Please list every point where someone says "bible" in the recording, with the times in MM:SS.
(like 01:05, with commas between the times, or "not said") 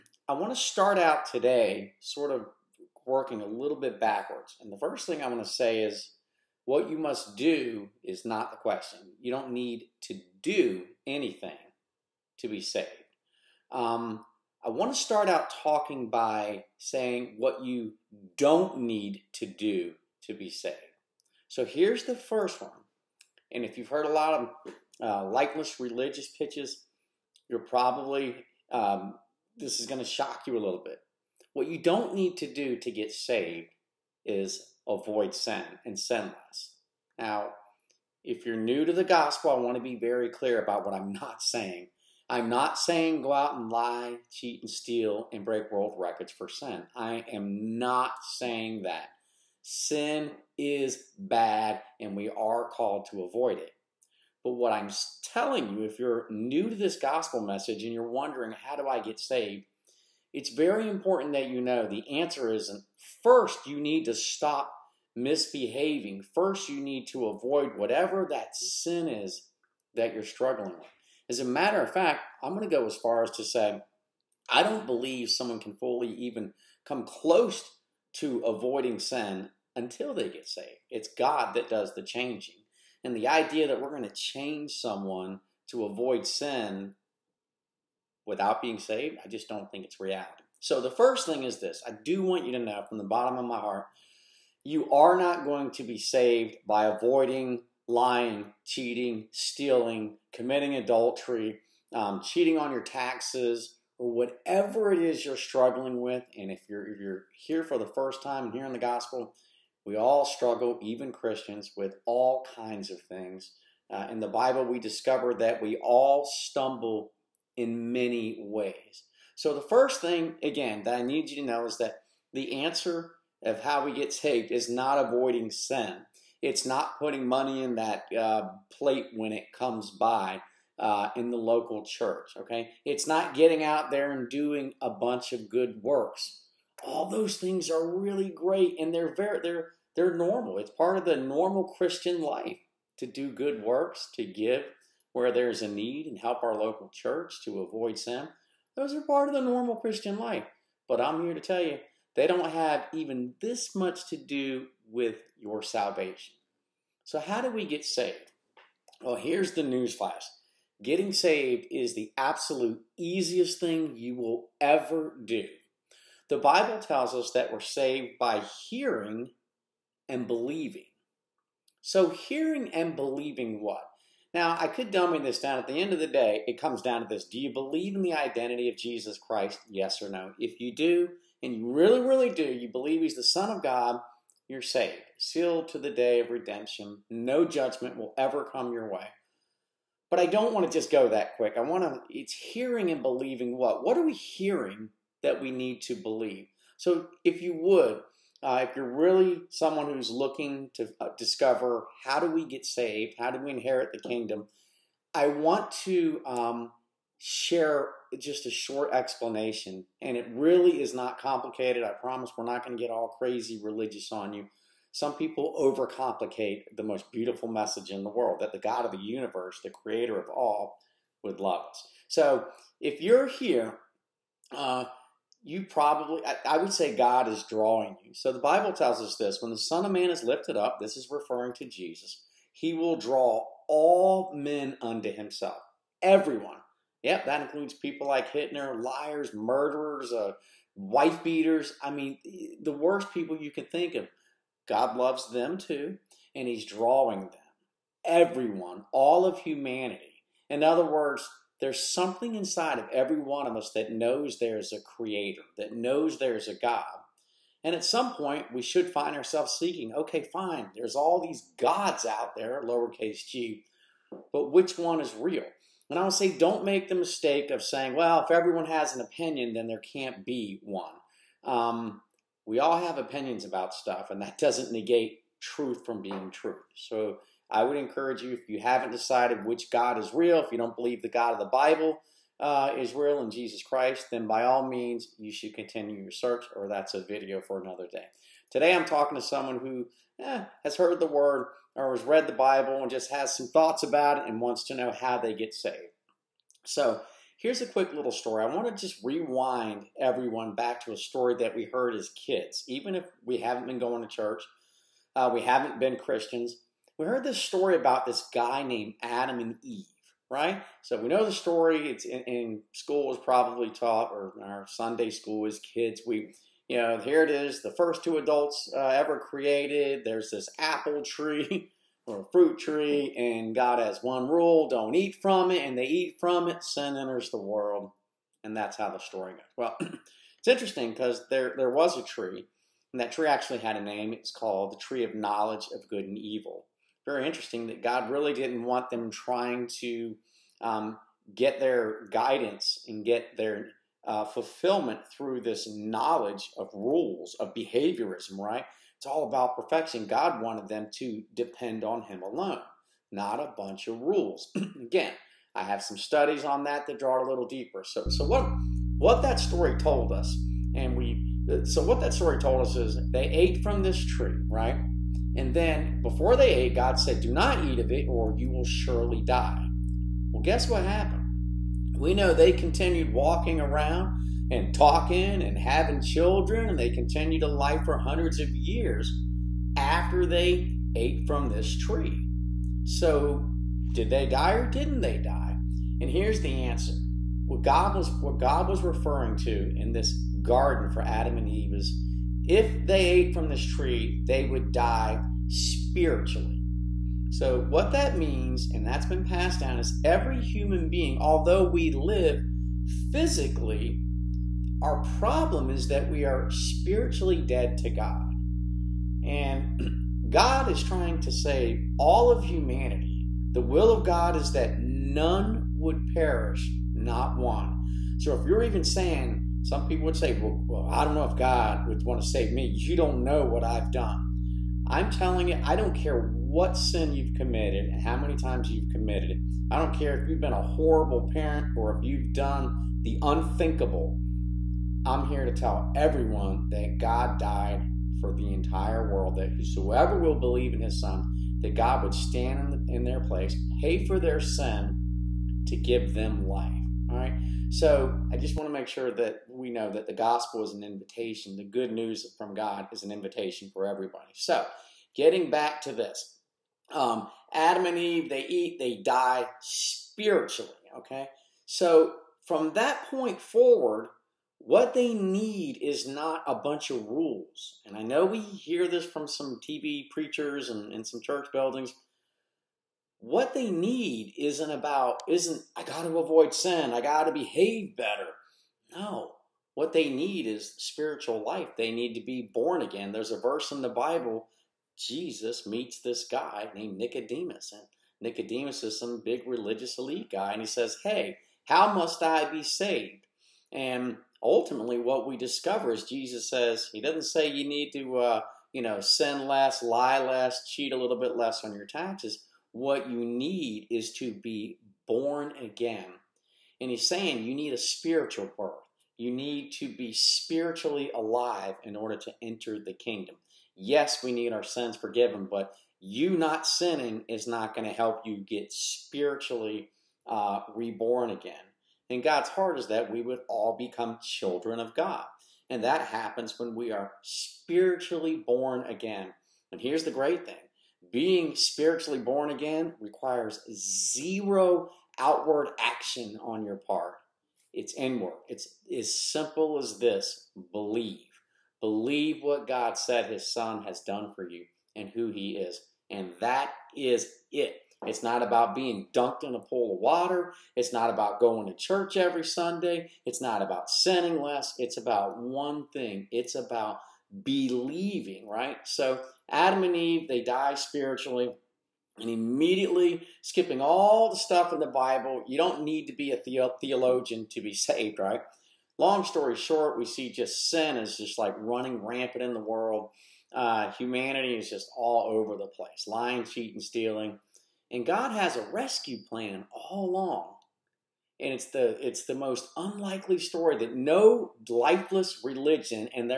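01:54, 02:46, 03:48, 04:41, 04:52, 08:03, 09:24.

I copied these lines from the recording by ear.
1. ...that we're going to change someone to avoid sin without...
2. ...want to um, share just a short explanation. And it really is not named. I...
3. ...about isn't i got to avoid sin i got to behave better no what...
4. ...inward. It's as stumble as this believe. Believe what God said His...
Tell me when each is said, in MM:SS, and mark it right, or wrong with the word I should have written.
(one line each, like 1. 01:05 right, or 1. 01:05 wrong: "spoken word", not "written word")
1. 01:23 right
2. 03:25 wrong: "complicated", not "named"
3. 07:54 right
4. 08:57 wrong: "simple", not "stumble".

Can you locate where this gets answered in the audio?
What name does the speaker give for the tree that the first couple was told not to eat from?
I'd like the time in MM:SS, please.
05:34.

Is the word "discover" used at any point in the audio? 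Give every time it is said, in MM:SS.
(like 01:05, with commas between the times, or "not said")
01:54, 03:21, 08:15.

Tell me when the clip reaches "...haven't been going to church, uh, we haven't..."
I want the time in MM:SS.
05:03.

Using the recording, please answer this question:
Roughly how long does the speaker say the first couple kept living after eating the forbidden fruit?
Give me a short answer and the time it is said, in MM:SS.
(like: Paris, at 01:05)
hundreds of years, at 06:17.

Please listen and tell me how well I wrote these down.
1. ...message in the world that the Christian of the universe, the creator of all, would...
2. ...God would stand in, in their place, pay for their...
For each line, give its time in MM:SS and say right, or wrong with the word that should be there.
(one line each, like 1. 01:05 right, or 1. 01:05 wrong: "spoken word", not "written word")
1. 03:37 wrong: "God", not "Christian"
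2. 07:21 right.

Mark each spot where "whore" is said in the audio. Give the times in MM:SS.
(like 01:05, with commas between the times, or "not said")
not said.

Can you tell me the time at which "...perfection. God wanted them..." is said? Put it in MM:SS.
05:49.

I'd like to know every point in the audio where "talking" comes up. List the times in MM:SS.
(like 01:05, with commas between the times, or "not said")
00:15, 04:48, 06:14.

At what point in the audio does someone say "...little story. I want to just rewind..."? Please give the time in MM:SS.
04:57.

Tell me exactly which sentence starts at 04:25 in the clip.
And I would say, don't make the mistake of saying, well, if everyone has an opinion, then there can't be one.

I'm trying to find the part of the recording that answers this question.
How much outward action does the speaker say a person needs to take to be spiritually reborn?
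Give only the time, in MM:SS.
08:53.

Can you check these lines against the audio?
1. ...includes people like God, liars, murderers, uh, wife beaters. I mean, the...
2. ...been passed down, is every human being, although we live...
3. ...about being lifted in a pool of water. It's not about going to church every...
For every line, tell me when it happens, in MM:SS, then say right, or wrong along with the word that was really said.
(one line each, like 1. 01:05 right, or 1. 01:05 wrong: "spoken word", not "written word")
1. 03:57 wrong: "Hitler", not "God"
2. 06:39 right
3. 09:08 wrong: "dunked", not "lifted".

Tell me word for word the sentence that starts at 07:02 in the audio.
You don't know what I've done.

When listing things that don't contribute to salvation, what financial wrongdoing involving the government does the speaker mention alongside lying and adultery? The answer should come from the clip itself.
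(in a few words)
cheating on your taxes.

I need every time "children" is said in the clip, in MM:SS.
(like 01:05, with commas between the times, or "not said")
06:16, 08:44.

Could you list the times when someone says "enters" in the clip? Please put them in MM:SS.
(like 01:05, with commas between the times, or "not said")
05:26, 08:32.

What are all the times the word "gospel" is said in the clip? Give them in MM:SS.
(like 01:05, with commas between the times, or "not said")
00:39, 00:56, 01:48, 07:30.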